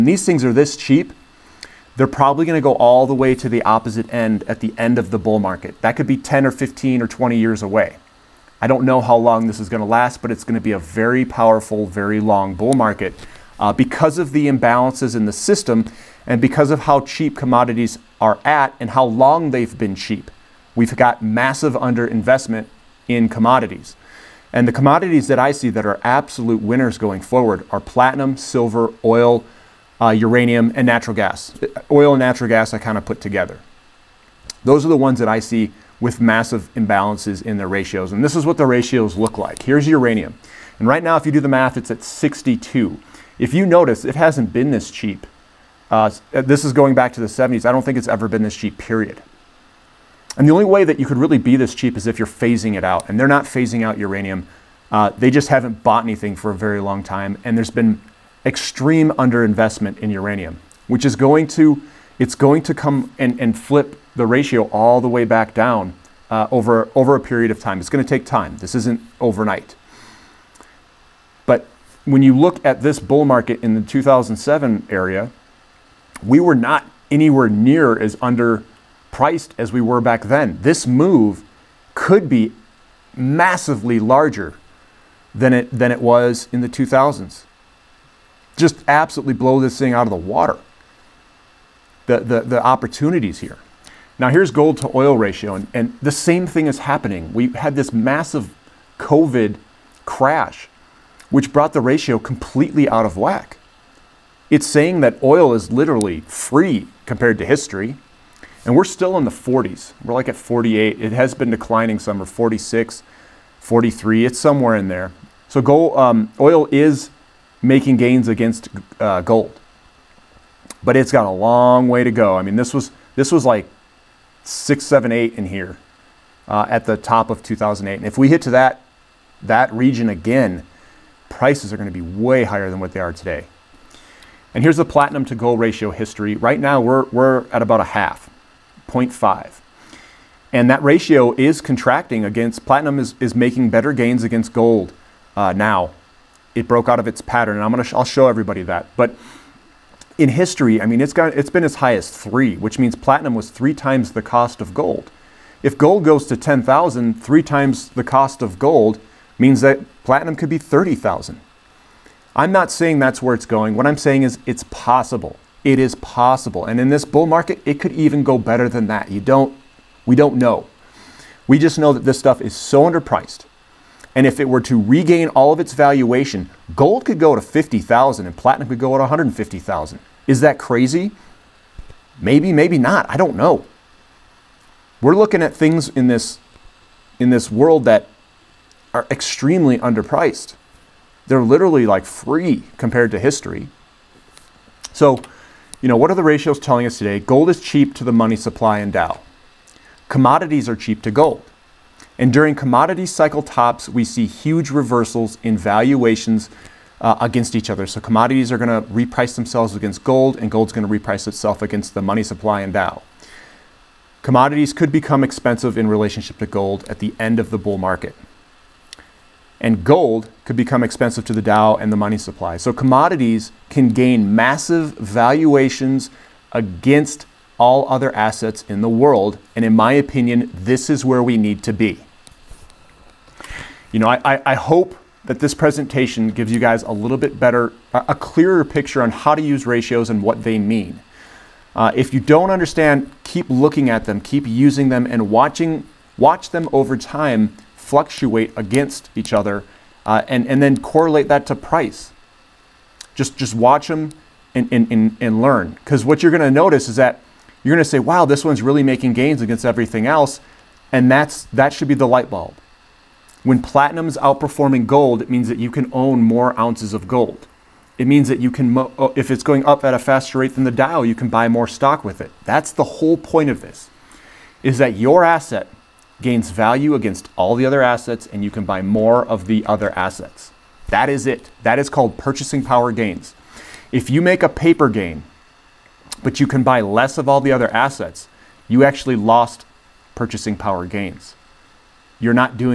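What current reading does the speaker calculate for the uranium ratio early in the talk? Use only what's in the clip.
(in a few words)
62.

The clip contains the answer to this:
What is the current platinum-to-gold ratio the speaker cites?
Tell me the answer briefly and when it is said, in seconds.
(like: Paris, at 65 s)
0.5, at 138 s.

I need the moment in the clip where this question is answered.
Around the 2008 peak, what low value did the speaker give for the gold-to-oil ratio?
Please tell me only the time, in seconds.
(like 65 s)
124 s.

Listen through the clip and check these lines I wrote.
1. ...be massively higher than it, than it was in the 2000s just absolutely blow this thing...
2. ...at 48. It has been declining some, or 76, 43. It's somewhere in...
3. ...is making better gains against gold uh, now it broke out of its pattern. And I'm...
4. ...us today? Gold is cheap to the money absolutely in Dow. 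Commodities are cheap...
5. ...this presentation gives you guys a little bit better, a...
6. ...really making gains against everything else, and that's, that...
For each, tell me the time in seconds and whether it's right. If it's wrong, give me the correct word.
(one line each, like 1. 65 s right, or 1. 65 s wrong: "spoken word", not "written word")
1. 82 s wrong: "larger", not "higher"
2. 110 s wrong: "46", not "76"
3. 143 s right
4. 196 s wrong: "supply", not "absolutely"
5. 235 s right
6. 258 s right.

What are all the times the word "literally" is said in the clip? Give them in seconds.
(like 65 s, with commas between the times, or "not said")
105 s, 191 s.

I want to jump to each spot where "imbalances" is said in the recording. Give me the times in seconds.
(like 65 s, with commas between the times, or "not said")
14 s, 36 s.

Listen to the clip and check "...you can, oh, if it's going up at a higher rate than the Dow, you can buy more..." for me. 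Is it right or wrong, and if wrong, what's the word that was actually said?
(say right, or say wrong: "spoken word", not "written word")
wrong: "faster", not "higher".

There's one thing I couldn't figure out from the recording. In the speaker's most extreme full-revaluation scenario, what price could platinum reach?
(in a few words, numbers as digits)
150,000.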